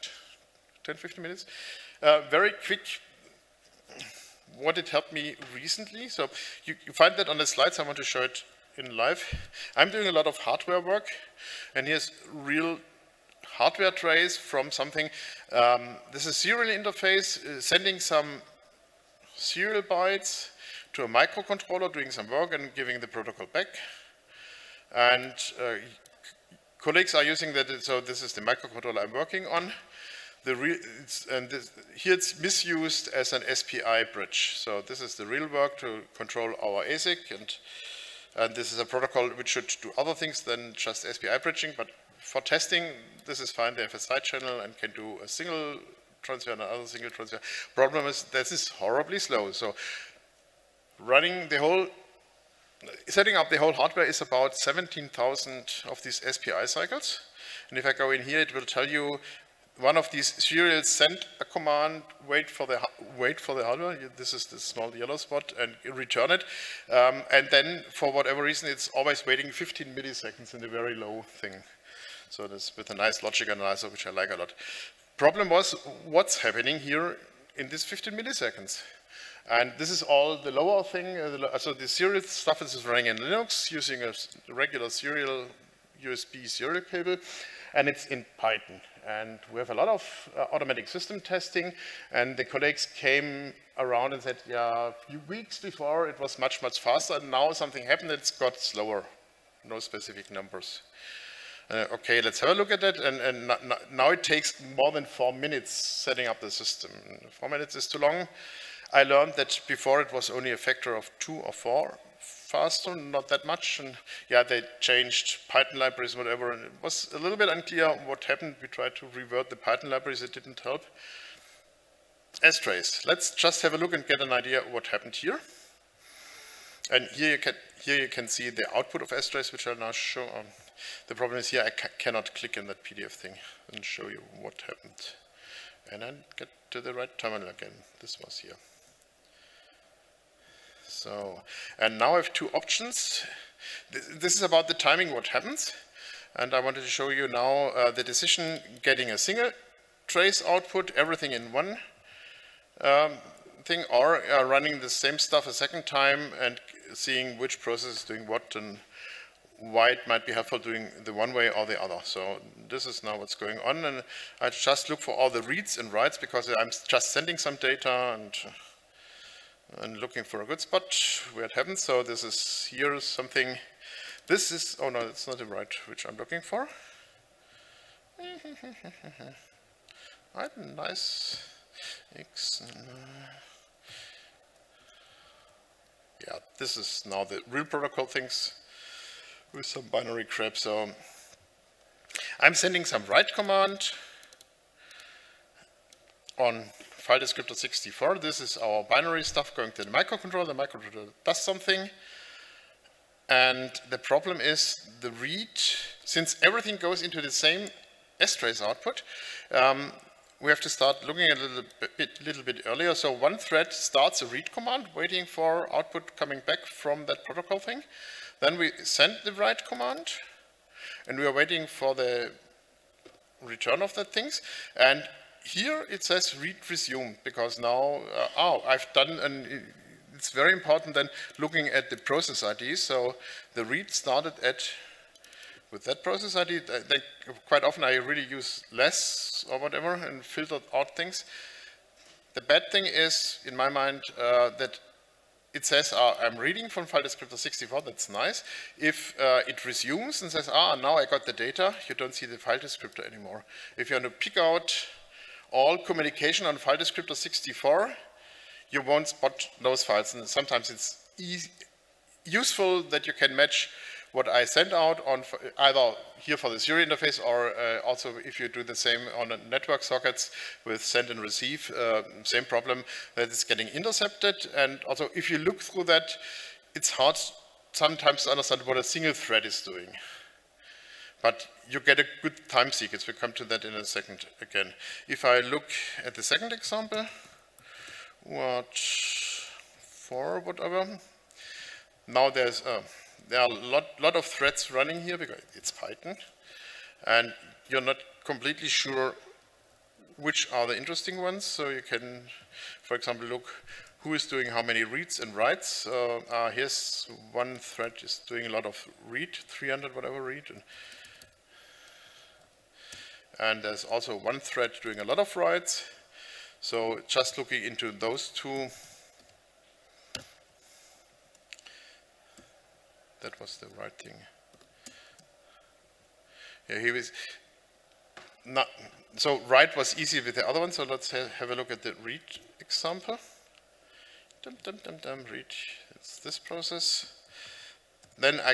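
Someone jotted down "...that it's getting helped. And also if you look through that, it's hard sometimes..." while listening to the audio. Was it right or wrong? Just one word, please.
wrong.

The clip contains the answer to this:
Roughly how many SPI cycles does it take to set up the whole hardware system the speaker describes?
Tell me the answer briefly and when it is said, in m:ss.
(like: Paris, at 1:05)
17,000, at 0:54.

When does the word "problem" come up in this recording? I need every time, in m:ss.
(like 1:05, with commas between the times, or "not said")
0:47, 1:15, 2:11, 3:23, 4:32.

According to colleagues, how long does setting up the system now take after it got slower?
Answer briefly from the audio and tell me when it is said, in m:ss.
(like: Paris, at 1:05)
More than four minutes, at 1:44.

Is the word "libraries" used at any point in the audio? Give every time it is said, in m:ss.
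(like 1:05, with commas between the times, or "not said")
1:55, 1:59.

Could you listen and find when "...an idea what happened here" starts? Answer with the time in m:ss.
2:04.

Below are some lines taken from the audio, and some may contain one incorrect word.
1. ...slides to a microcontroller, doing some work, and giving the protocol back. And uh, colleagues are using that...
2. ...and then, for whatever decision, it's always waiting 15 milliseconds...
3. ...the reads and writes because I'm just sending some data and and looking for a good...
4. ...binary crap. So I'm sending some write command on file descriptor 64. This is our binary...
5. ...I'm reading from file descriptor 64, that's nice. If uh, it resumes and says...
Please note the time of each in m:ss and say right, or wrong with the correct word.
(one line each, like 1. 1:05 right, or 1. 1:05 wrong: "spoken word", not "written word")
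1. 0:19 wrong: "bytes", not "slides"
2. 1:07 wrong: "reason", not "decision"
3. 2:45 right
4. 3:09 right
5. 4:06 right.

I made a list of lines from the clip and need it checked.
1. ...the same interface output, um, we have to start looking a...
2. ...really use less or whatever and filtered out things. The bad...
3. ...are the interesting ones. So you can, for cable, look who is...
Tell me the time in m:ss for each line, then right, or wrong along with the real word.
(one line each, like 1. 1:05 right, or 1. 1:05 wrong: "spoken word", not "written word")
1. 3:27 wrong: "strace", not "interface"
2. 3:57 right
3. 5:00 wrong: "example", not "cable".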